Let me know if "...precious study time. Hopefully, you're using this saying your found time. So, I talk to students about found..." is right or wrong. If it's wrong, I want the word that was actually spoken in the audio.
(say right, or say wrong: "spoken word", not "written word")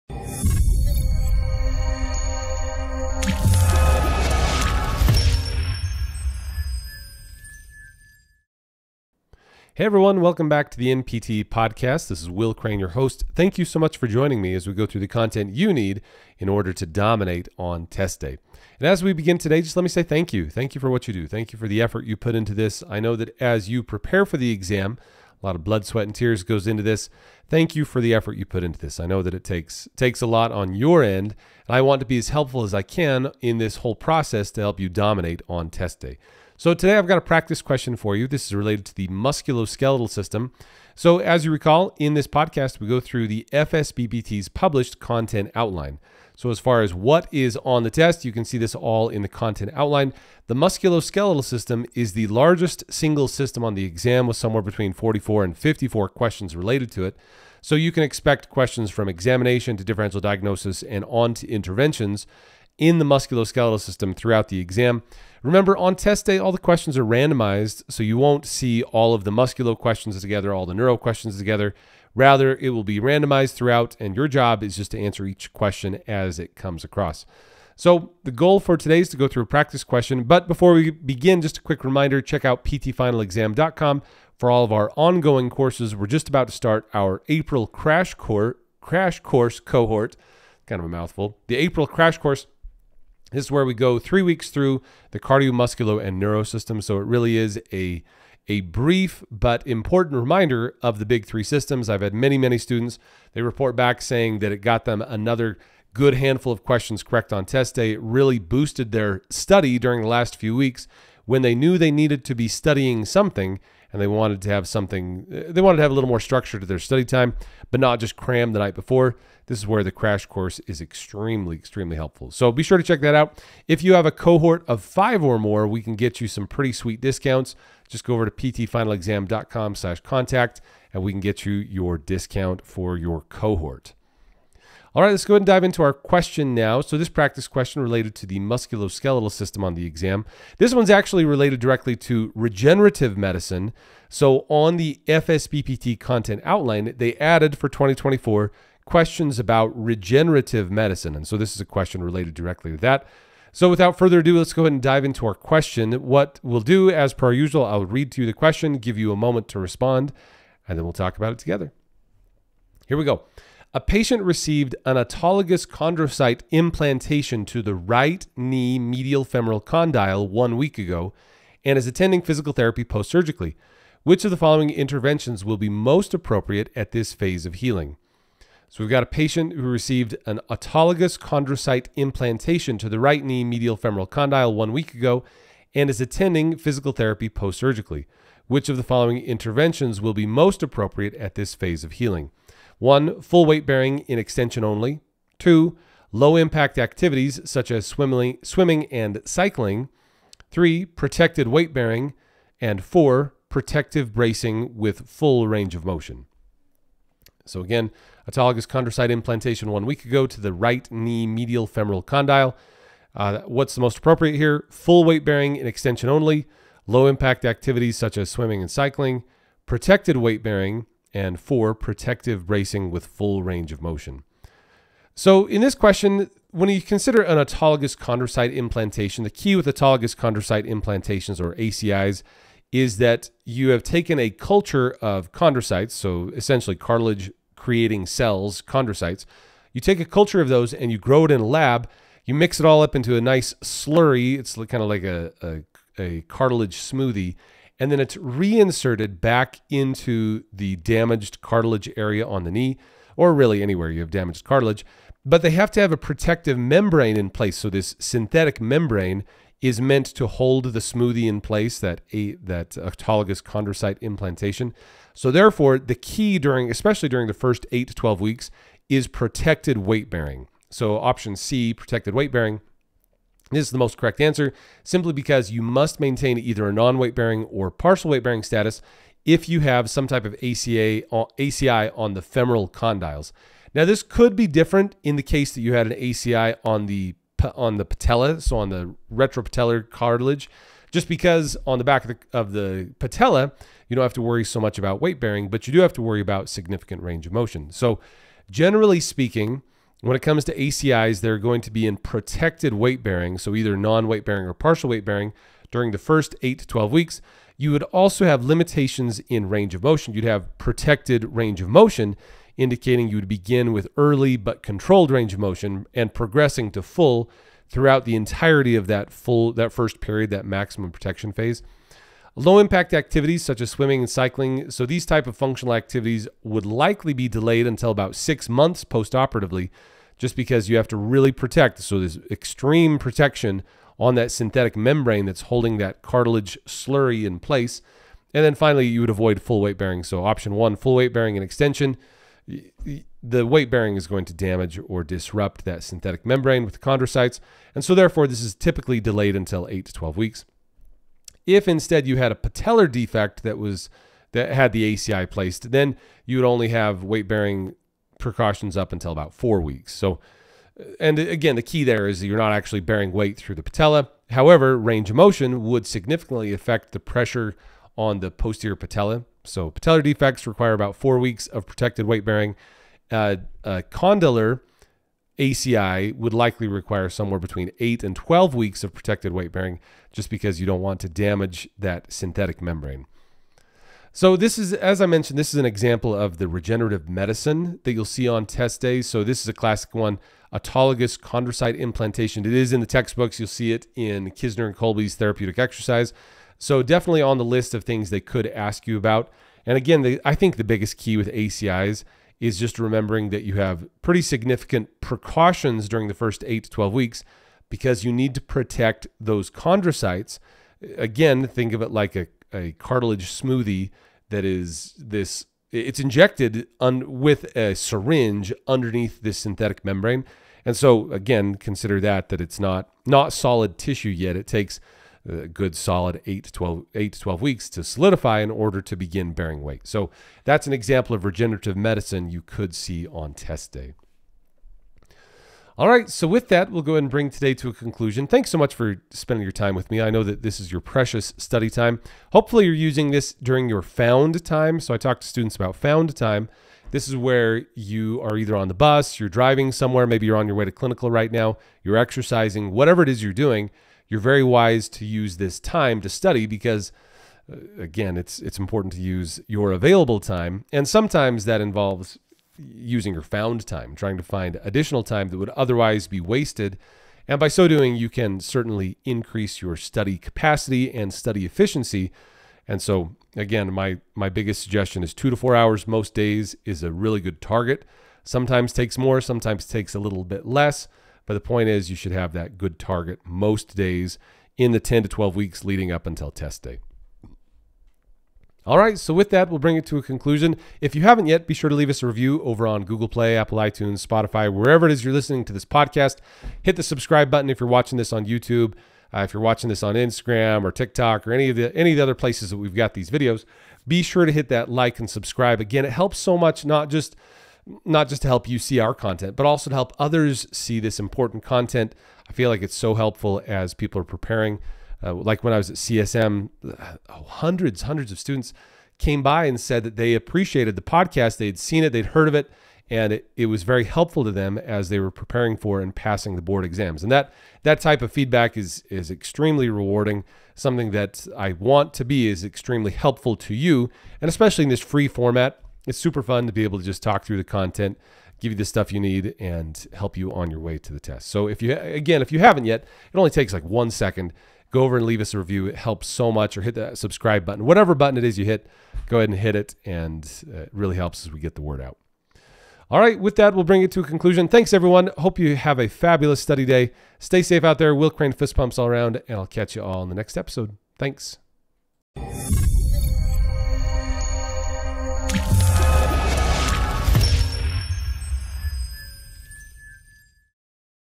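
wrong: "during", not "saying".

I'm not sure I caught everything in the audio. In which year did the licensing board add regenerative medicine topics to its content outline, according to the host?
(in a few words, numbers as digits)
2024.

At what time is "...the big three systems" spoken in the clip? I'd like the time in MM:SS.
01:40.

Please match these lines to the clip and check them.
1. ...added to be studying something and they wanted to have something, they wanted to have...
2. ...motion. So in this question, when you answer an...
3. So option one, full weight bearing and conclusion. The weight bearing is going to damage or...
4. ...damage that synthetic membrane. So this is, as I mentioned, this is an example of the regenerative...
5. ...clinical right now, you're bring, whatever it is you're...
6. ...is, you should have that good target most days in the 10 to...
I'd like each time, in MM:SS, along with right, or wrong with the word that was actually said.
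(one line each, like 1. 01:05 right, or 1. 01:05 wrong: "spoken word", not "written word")
1. 01:51 wrong: "needed", not "added"
2. 03:43 wrong: "consider", not "answer"
3. 05:40 wrong: "extension", not "conclusion"
4. 06:21 right
5. 07:30 wrong: "exercising", not "bring"
6. 08:01 right.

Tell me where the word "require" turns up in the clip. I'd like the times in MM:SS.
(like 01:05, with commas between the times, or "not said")
06:10, 06:16.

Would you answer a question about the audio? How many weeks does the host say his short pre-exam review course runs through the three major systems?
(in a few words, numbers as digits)
3.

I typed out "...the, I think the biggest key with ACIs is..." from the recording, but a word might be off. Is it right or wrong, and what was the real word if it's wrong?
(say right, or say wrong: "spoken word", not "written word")
right.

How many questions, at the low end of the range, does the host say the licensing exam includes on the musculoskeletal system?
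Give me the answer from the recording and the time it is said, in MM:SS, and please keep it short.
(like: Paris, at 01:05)
44, at 00:54.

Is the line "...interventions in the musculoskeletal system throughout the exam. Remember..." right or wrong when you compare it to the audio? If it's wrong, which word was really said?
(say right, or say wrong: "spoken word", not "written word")
right.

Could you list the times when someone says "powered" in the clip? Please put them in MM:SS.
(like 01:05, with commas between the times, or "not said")
not said.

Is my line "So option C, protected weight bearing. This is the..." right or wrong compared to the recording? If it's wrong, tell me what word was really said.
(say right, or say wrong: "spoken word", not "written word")
right.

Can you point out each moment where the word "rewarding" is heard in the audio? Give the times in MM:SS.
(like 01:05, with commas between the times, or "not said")
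08:49.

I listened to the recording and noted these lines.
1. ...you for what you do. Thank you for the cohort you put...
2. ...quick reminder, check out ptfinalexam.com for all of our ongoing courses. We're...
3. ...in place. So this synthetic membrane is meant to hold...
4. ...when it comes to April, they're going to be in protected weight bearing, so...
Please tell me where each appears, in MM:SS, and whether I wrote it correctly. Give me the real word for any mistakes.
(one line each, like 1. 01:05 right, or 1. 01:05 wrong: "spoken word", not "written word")
1. 00:20 wrong: "effort", not "cohort"
2. 01:21 right
3. 04:17 right
4. 05:00 wrong: "ACIs", not "April".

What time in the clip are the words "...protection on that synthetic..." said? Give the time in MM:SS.
05:32.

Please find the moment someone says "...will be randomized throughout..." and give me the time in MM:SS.
01:12.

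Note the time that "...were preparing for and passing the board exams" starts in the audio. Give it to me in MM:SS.
08:44.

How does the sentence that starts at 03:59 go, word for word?
You take a culture of those and you grow it in a lab.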